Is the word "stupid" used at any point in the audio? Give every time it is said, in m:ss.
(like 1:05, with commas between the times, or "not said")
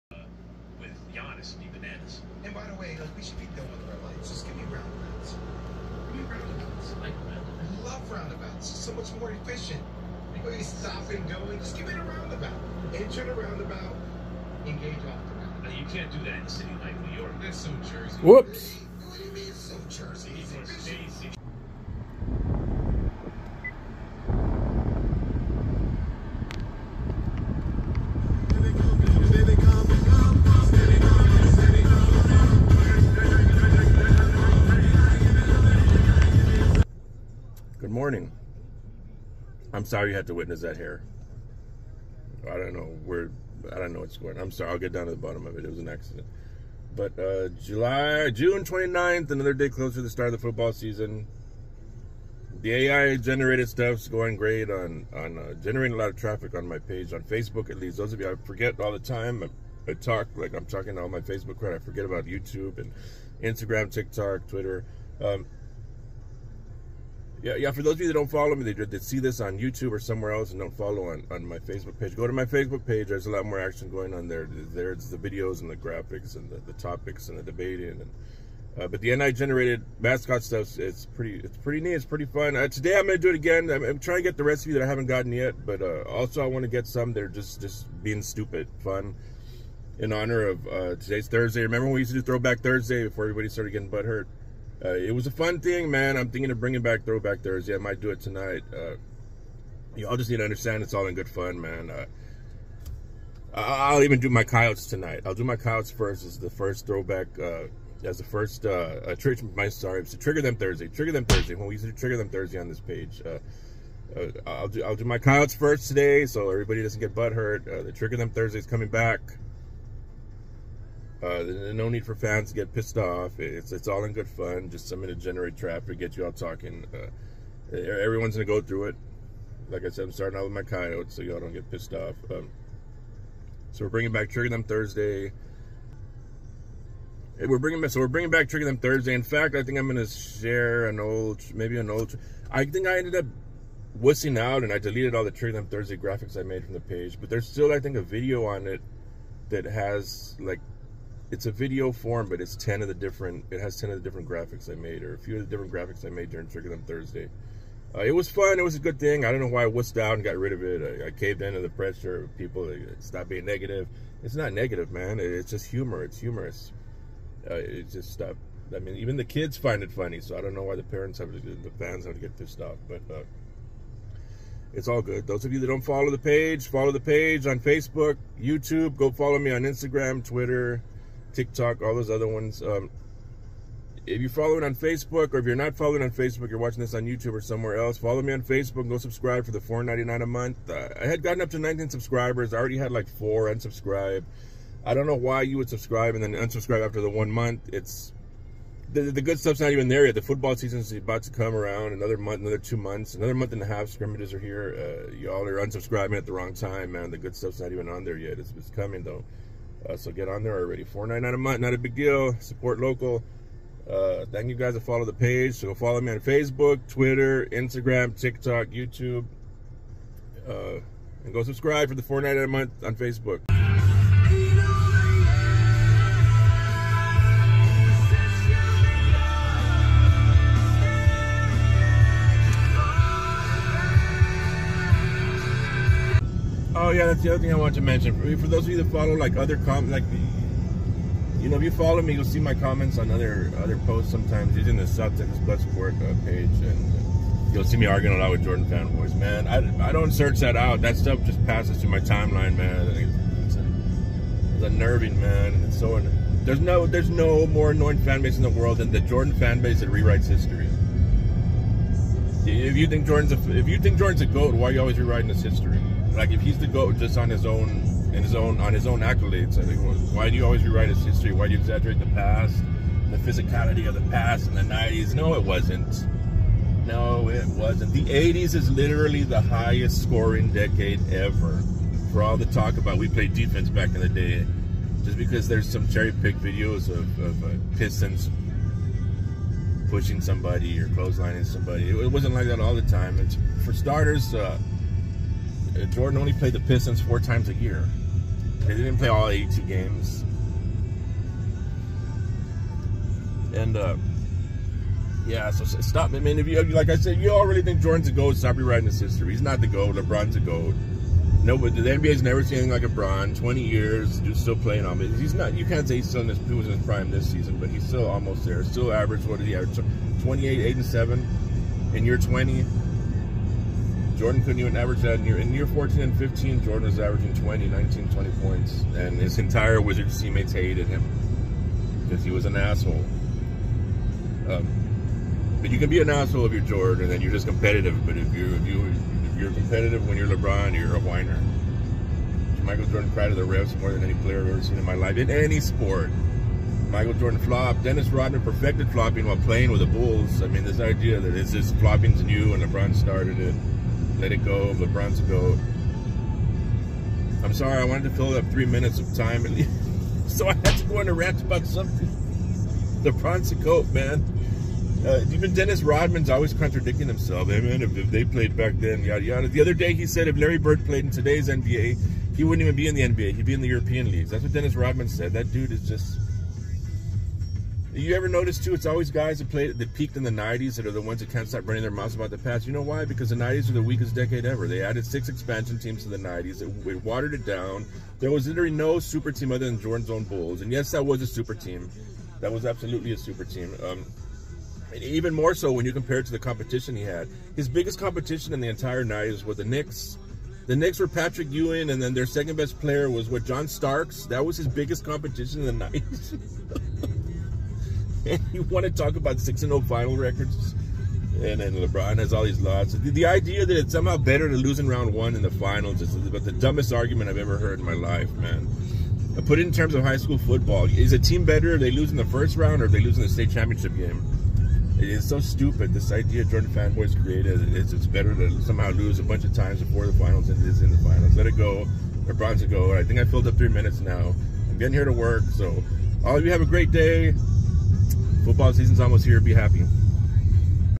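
1:28, 7:05.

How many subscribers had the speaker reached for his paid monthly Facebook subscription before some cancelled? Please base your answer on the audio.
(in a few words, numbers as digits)
19.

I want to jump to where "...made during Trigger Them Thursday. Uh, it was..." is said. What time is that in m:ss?
2:36.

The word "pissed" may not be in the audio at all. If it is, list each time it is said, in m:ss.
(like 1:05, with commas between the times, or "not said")
2:02, 2:11, 2:52.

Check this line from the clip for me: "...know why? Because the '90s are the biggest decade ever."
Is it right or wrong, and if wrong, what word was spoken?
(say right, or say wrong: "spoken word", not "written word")
wrong: "weakest", not "biggest".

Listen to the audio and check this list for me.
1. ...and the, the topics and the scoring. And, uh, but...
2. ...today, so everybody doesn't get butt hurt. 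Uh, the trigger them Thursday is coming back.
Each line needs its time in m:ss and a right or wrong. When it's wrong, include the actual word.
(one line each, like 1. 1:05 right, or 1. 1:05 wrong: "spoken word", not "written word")
1. 1:16 wrong: "debating", not "scoring"
2. 1:55 right.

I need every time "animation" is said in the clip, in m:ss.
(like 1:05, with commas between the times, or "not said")
not said.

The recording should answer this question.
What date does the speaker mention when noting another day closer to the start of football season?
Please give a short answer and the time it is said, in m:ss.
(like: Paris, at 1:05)
June 29th, at 0:48.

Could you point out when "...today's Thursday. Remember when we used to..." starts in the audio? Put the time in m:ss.
1:30.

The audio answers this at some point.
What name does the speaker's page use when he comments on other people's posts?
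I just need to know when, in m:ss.
4:04.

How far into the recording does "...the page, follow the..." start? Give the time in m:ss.
2:56.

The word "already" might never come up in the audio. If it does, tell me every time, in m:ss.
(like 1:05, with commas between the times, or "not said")
3:12, 3:30, 5:07.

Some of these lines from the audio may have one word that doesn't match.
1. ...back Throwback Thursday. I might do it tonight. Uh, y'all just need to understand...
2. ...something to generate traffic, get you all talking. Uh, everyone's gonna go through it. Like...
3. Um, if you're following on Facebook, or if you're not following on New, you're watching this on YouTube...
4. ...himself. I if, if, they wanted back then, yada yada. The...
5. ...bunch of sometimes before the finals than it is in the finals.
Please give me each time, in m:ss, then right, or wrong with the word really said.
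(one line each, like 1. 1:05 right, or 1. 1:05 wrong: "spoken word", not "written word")
1. 1:36 right
2. 2:04 right
3. 3:02 wrong: "Facebook", not "New"
4. 6:07 wrong: "played", not "wanted"
5. 7:09 wrong: "times", not "sometimes".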